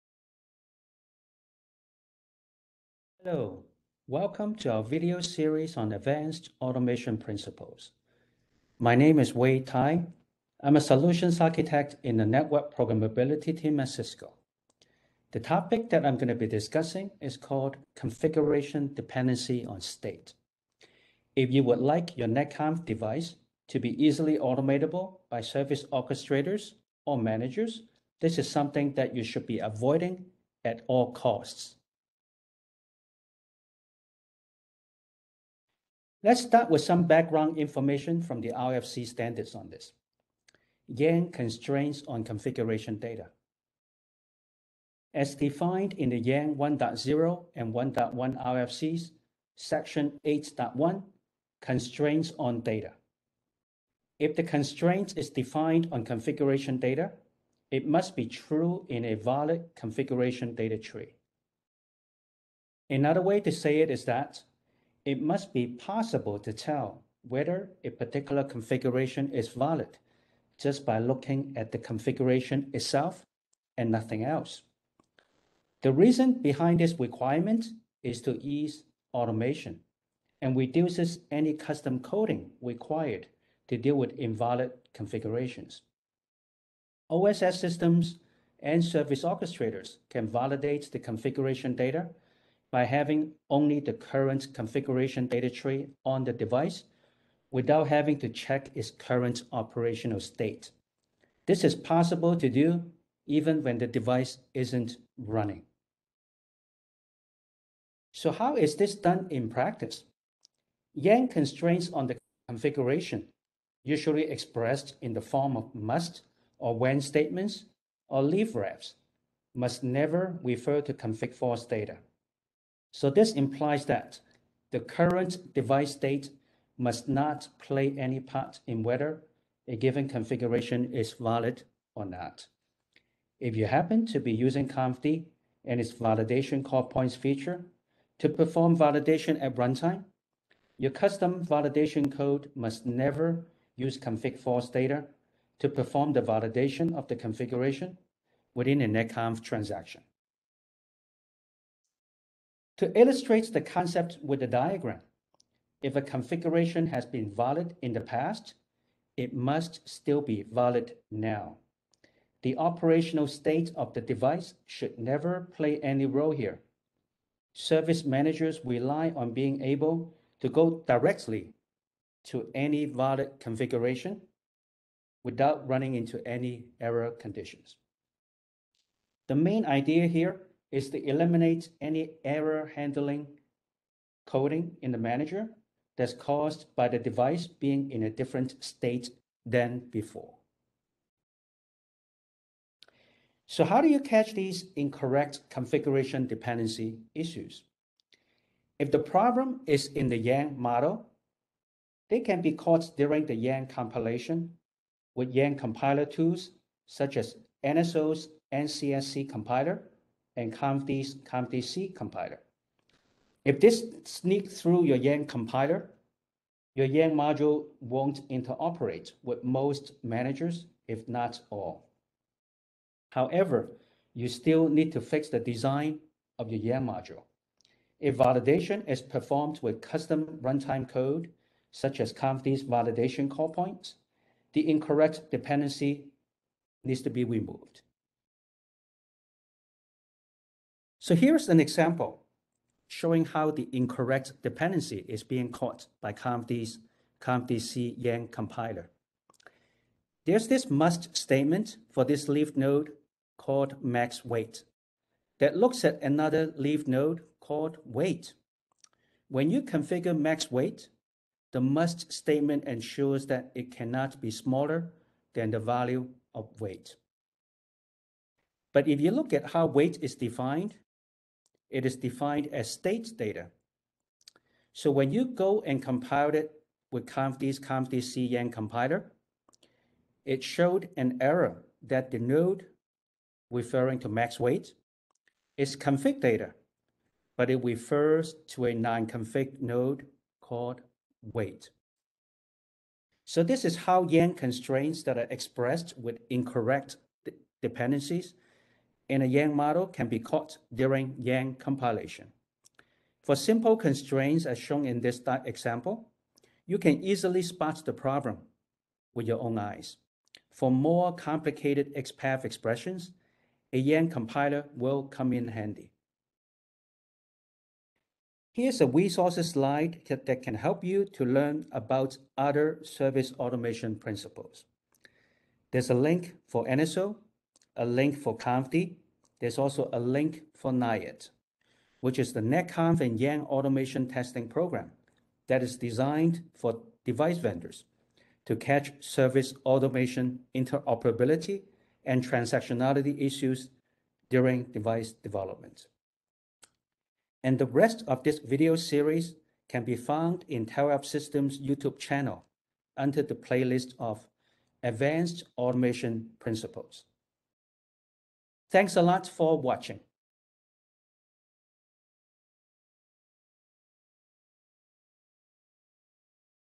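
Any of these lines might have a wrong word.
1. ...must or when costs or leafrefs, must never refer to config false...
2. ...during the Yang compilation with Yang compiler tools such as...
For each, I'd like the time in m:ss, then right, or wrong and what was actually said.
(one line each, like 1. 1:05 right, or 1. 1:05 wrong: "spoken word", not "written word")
1. 1:55 wrong: "statements", not "costs"
2. 3:22 right.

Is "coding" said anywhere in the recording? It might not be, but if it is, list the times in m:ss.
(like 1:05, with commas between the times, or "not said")
1:21, 3:04.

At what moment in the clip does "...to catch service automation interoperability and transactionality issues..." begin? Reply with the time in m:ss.
5:38.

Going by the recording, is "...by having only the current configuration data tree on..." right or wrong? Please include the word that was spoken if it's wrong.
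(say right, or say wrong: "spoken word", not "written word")
right.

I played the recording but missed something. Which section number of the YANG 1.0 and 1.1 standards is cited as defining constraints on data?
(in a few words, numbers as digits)
8.1.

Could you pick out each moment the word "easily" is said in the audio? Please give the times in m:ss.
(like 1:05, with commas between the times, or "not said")
0:24, 5:07.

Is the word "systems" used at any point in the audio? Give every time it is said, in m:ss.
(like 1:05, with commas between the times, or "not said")
1:27, 5:51.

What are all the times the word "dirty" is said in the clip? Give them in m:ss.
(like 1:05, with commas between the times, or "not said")
not said.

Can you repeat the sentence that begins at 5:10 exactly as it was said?
For more complicated XPath expressions, a Yang compiler will come in handy.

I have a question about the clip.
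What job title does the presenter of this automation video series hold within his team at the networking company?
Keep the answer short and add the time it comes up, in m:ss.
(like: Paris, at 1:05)
Solutions architect, at 0:10.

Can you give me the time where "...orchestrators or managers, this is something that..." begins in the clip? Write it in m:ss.
0:25.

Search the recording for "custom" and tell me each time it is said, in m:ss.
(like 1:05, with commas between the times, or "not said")
1:21, 2:20, 3:49.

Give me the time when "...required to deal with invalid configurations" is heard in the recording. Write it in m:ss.
1:22.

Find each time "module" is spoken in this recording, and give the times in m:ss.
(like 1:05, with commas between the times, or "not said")
3:37, 3:46.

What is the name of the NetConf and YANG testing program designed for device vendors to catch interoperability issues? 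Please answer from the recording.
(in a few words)
NIAID.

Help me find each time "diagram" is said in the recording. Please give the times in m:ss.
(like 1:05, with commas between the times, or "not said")
2:34.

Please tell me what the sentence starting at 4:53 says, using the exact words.
So this is how Yang constraints that are expressed with incorrect dependencies and a Yang model can be caught during Yang compilation.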